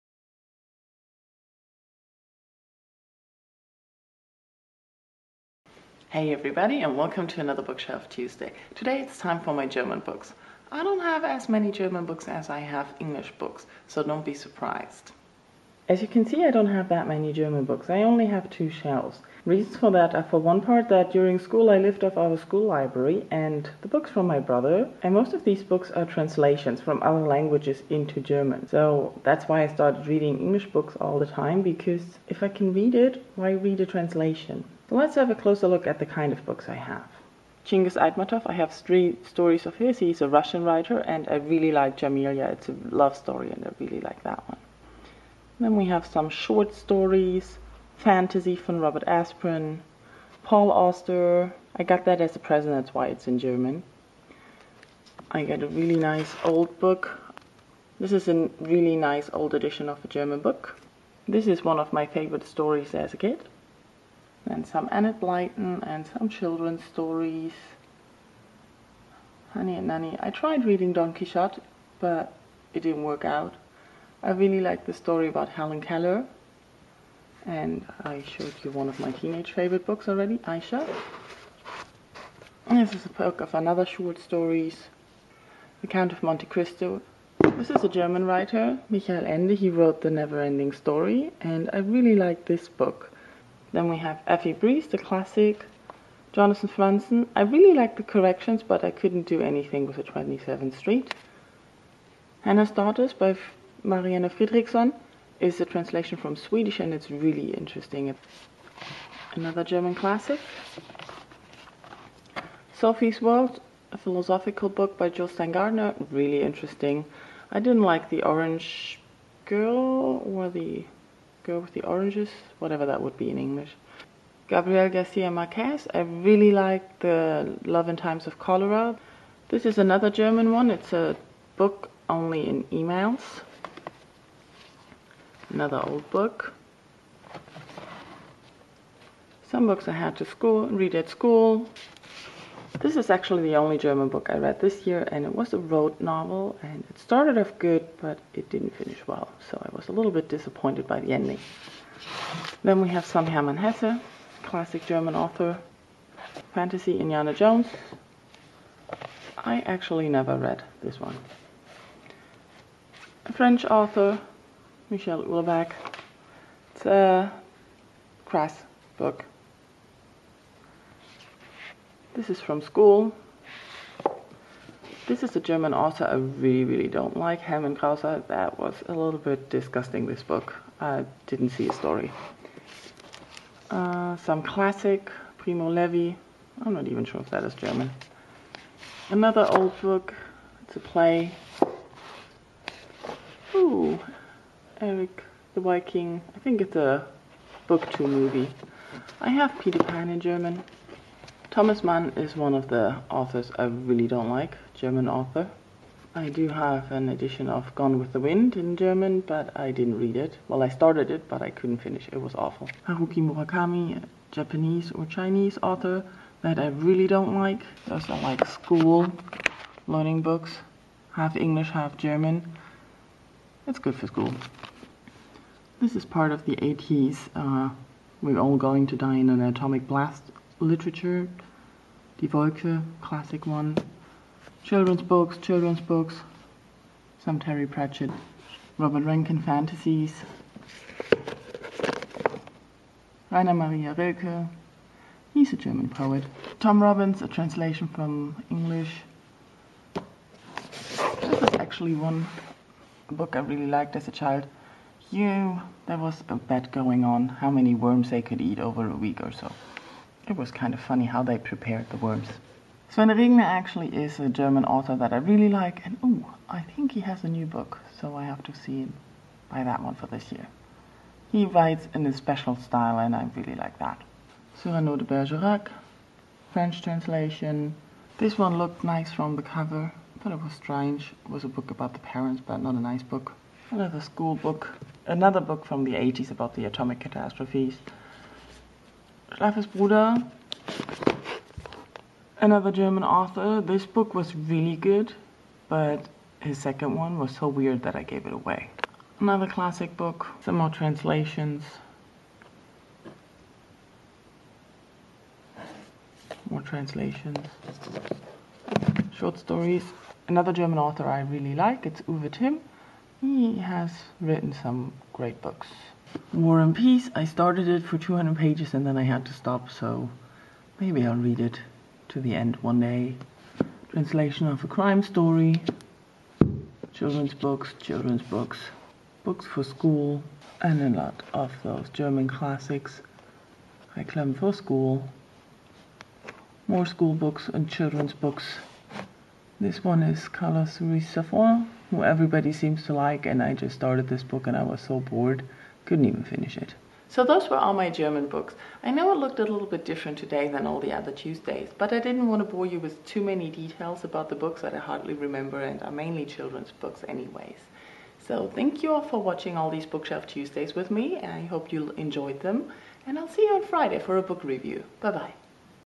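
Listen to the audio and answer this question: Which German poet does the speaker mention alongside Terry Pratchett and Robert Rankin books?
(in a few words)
Rainer Maria Rilke.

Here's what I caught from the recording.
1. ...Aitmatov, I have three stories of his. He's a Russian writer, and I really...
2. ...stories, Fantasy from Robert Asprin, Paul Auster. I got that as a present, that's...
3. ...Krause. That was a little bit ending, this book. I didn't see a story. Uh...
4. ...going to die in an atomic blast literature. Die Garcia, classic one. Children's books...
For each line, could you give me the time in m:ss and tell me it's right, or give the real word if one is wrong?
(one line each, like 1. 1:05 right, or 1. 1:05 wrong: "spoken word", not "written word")
1. 0:37 right
2. 0:46 right
3. 2:57 wrong: "disgusting", not "ending"
4. 3:48 wrong: "Wolke", not "Garcia".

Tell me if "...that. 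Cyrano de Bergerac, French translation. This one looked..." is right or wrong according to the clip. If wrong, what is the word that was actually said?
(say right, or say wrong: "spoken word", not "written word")
right.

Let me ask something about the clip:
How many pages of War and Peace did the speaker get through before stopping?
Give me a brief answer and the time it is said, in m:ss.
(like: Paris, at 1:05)
200, at 5:17.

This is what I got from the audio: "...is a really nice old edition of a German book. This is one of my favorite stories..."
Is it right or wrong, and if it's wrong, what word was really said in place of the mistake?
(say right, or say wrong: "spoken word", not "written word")
right.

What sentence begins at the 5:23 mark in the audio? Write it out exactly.
Translation of a crime story, children's books, children's books, books for school, and a lot of those German classics.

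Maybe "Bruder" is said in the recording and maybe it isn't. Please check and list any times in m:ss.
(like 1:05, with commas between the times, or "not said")
4:49.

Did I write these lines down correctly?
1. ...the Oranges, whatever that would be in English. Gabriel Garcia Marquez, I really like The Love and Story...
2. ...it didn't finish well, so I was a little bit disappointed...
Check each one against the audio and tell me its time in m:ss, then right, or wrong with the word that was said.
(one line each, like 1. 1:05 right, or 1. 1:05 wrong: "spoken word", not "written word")
1. 2:01 wrong: "Times", not "Story"
2. 2:28 right.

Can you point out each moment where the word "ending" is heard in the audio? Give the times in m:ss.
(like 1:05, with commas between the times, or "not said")
1:30, 2:31.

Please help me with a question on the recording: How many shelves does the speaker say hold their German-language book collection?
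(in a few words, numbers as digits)
2.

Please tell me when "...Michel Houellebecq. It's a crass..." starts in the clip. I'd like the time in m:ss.
2:44.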